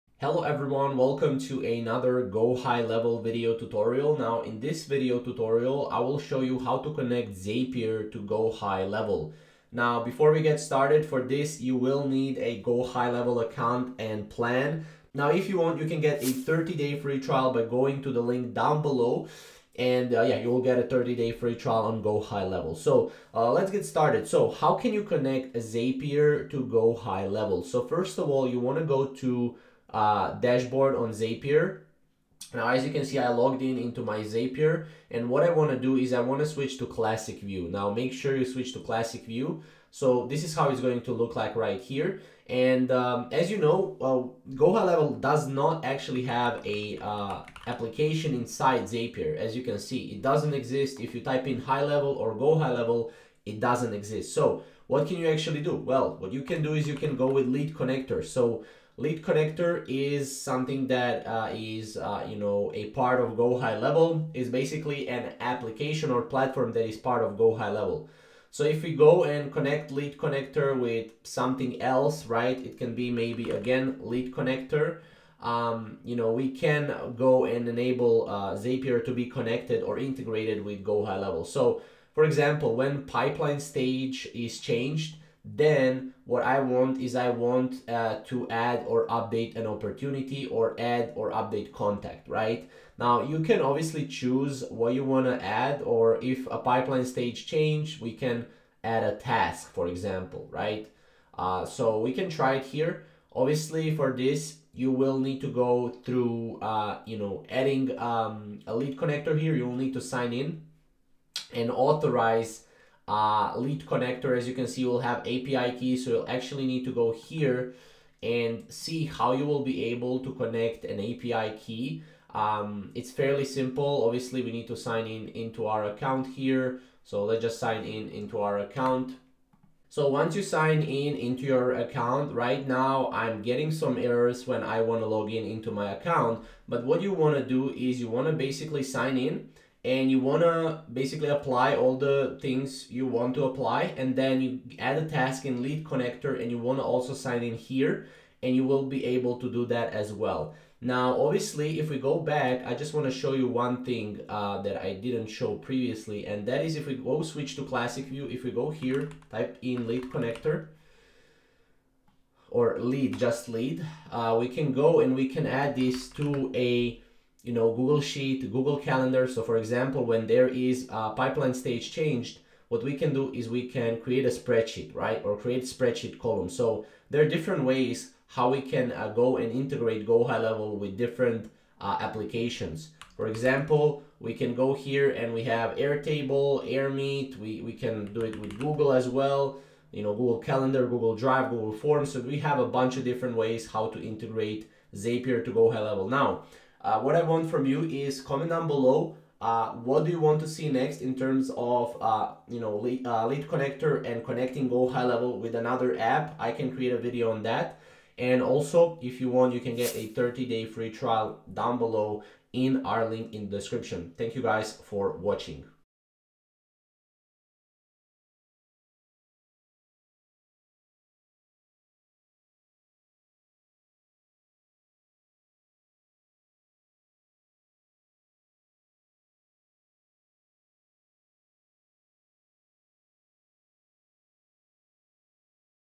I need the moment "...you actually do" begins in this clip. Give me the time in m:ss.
0:55.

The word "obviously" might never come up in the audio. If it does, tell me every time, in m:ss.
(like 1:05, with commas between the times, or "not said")
1:33, 1:43, 2:04, 2:31.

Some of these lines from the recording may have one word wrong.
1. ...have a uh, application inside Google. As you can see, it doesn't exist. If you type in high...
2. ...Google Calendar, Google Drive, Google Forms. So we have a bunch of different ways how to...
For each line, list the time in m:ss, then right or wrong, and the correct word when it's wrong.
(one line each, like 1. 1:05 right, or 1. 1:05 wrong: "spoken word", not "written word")
1. 0:46 wrong: "Zapier", not "Google"
2. 3:10 right.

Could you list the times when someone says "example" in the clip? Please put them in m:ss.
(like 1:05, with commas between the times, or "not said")
1:22, 1:39, 2:49, 3:03.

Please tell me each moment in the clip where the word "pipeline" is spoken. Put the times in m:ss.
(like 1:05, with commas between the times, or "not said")
1:23, 1:36, 2:51.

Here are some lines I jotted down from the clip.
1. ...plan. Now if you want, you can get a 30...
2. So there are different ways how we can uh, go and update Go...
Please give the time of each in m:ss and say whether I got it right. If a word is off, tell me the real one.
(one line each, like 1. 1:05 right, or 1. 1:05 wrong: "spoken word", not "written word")
1. 0:14 right
2. 2:56 wrong: "integrate", not "update".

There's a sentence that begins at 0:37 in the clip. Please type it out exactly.
Now, make sure you switch to classic view.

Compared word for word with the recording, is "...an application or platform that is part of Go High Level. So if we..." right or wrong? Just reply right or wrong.
right.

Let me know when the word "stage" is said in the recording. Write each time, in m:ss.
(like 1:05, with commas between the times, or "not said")
1:23, 1:37, 2:51.